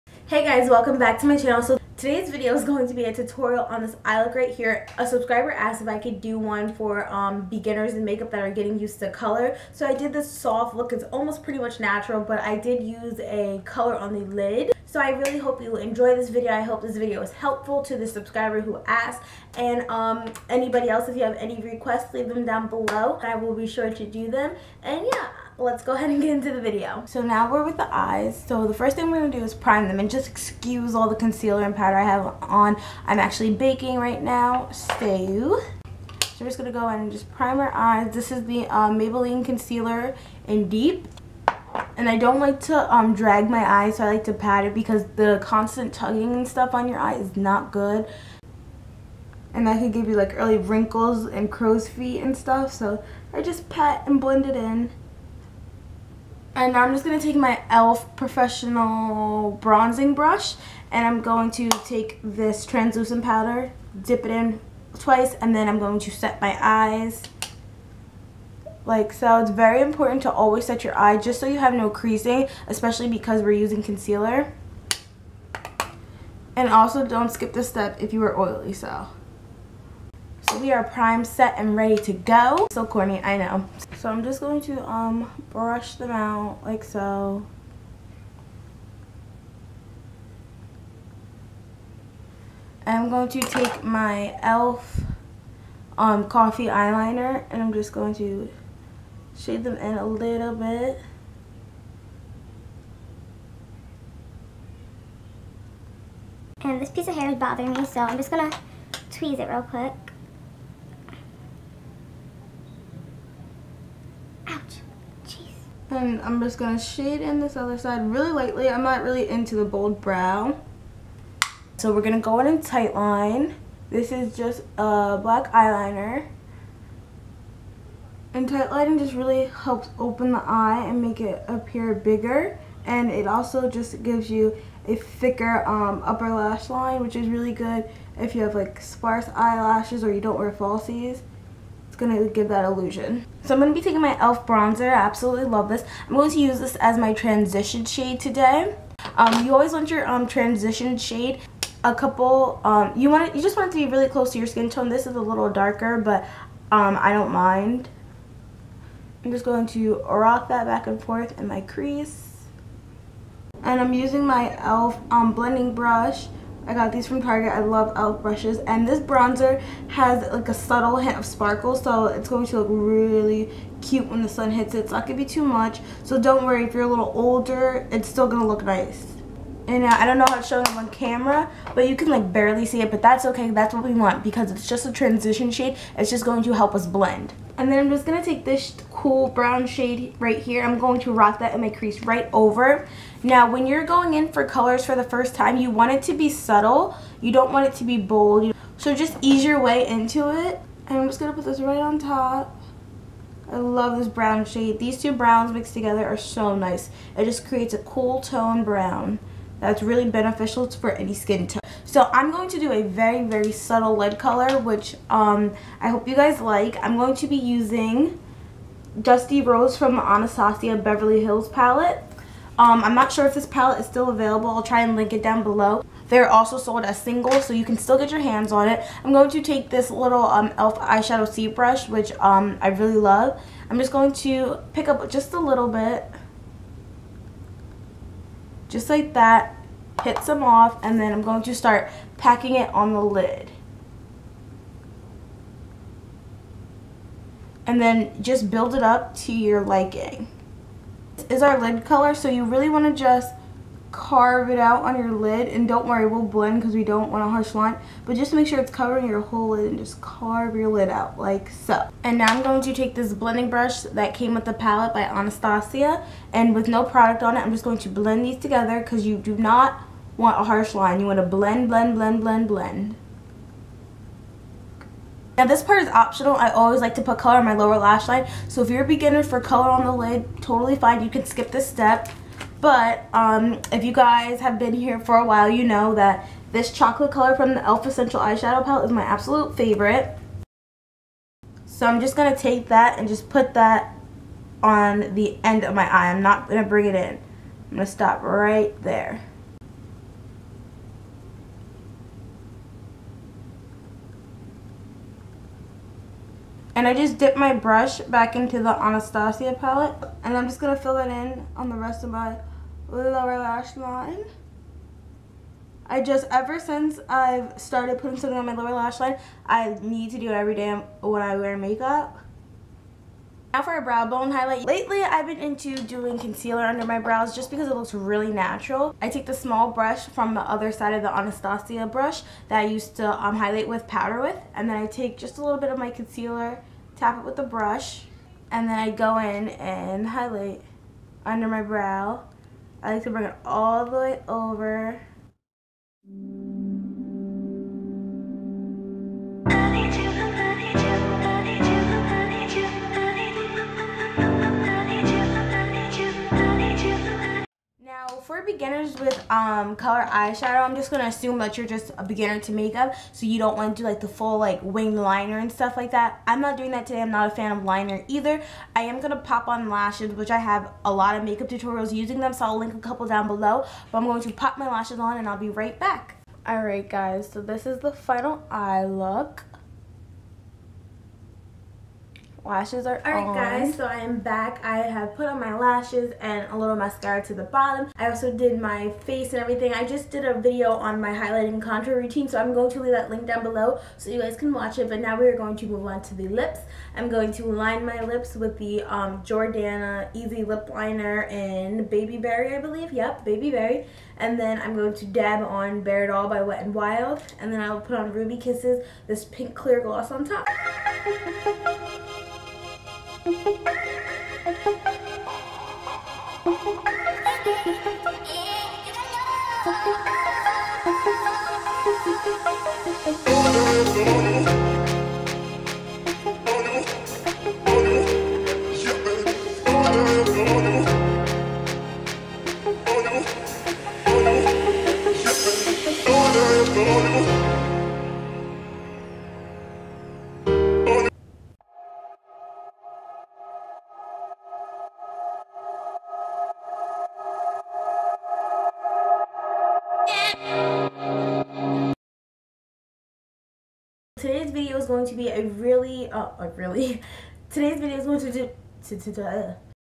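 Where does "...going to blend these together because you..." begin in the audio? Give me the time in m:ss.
4:27.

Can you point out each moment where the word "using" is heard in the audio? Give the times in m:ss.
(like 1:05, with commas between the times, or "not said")
1:13, 2:43, 3:37, 6:11.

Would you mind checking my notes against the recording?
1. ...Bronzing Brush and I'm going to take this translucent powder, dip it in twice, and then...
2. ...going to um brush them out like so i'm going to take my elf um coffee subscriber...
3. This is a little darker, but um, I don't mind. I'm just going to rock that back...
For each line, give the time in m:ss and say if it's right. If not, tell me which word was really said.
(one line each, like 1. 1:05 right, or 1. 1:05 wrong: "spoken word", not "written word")
1. 0:59 right
2. 1:24 wrong: "eyeliner", not "subscriber"
3. 2:34 right.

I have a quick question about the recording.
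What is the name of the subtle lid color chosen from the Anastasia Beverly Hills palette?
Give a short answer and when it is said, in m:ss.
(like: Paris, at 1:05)
Dusty Rose, at 3:38.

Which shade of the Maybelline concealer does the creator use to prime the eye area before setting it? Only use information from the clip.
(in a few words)
Deep.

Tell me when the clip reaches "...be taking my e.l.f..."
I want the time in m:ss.
2:23.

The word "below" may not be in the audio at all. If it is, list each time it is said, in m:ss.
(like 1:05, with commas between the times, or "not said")
0:22, 3:45, 6:13, 6:33.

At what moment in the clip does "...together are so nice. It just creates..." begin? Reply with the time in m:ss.
3:25.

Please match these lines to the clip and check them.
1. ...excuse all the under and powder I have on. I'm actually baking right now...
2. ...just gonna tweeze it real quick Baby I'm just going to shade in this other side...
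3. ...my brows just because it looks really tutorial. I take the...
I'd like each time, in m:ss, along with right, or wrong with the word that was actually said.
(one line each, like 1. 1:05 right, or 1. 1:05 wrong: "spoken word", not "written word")
1. 0:30 wrong: "concealer", not "under"
2. 1:48 wrong: "And", not "Baby"
3. 5:26 wrong: "natural", not "tutorial".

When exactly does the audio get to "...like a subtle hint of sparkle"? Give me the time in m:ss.
2:50.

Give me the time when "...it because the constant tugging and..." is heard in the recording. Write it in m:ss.
0:44.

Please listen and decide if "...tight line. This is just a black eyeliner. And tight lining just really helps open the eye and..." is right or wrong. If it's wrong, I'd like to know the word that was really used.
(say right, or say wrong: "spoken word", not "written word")
right.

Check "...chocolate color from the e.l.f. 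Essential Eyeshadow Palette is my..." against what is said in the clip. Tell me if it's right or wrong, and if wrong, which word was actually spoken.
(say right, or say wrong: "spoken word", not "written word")
right.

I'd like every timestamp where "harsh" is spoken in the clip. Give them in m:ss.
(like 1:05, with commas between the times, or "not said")
4:17, 4:30.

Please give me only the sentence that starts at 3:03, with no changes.
That's what we want because it's just a transition shade.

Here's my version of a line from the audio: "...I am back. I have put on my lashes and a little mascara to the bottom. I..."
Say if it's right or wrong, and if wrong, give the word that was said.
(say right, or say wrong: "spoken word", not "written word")
right.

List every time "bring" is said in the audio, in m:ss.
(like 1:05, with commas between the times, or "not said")
4:56, 5:43.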